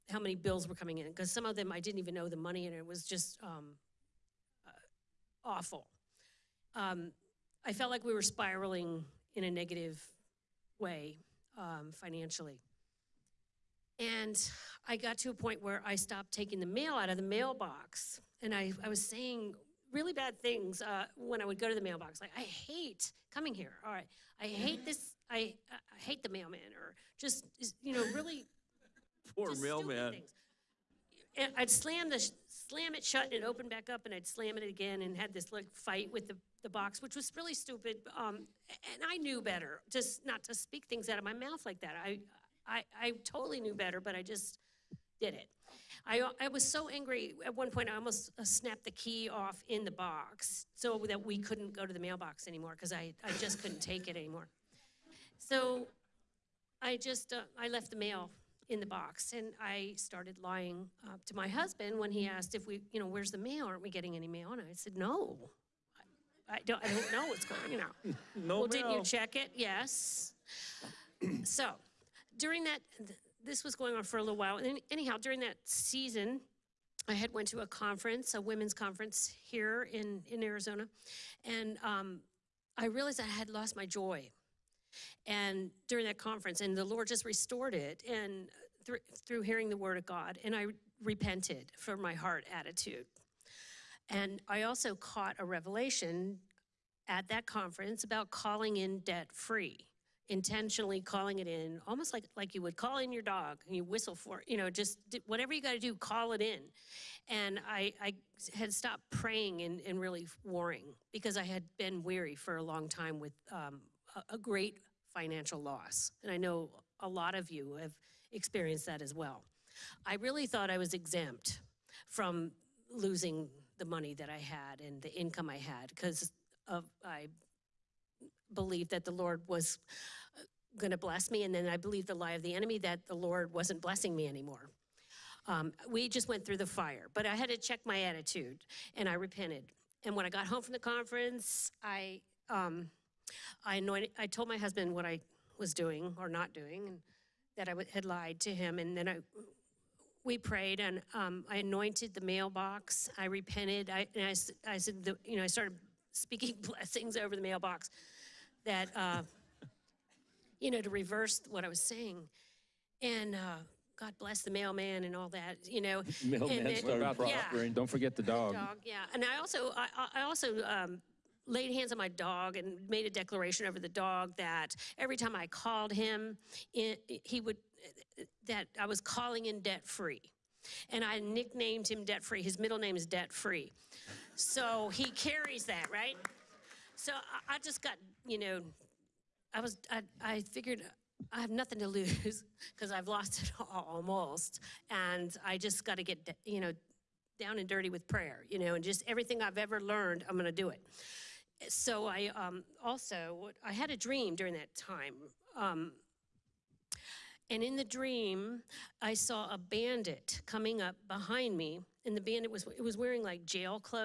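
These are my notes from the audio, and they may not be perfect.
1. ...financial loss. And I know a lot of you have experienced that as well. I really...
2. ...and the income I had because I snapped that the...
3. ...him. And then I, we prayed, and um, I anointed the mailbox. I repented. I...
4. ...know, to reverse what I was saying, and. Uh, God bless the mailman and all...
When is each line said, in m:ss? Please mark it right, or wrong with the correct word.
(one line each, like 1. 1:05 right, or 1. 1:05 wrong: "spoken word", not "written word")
1. 1:55 right
2. 2:04 wrong: "believed", not "snapped"
3. 2:28 right
4. 2:40 right.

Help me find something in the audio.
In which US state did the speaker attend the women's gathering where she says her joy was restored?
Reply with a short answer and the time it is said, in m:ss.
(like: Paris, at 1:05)
Arizona, at 1:20.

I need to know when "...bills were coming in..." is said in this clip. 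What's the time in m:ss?
0:00.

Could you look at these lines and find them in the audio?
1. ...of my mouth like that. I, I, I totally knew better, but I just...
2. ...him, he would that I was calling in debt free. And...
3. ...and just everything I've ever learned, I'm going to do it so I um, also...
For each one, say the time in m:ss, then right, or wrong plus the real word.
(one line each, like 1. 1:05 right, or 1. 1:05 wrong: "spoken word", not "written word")
1. 0:41 right
2. 2:55 right
3. 3:18 right.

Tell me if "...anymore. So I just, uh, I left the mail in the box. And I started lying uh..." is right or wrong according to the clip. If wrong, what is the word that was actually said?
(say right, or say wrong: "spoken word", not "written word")
right.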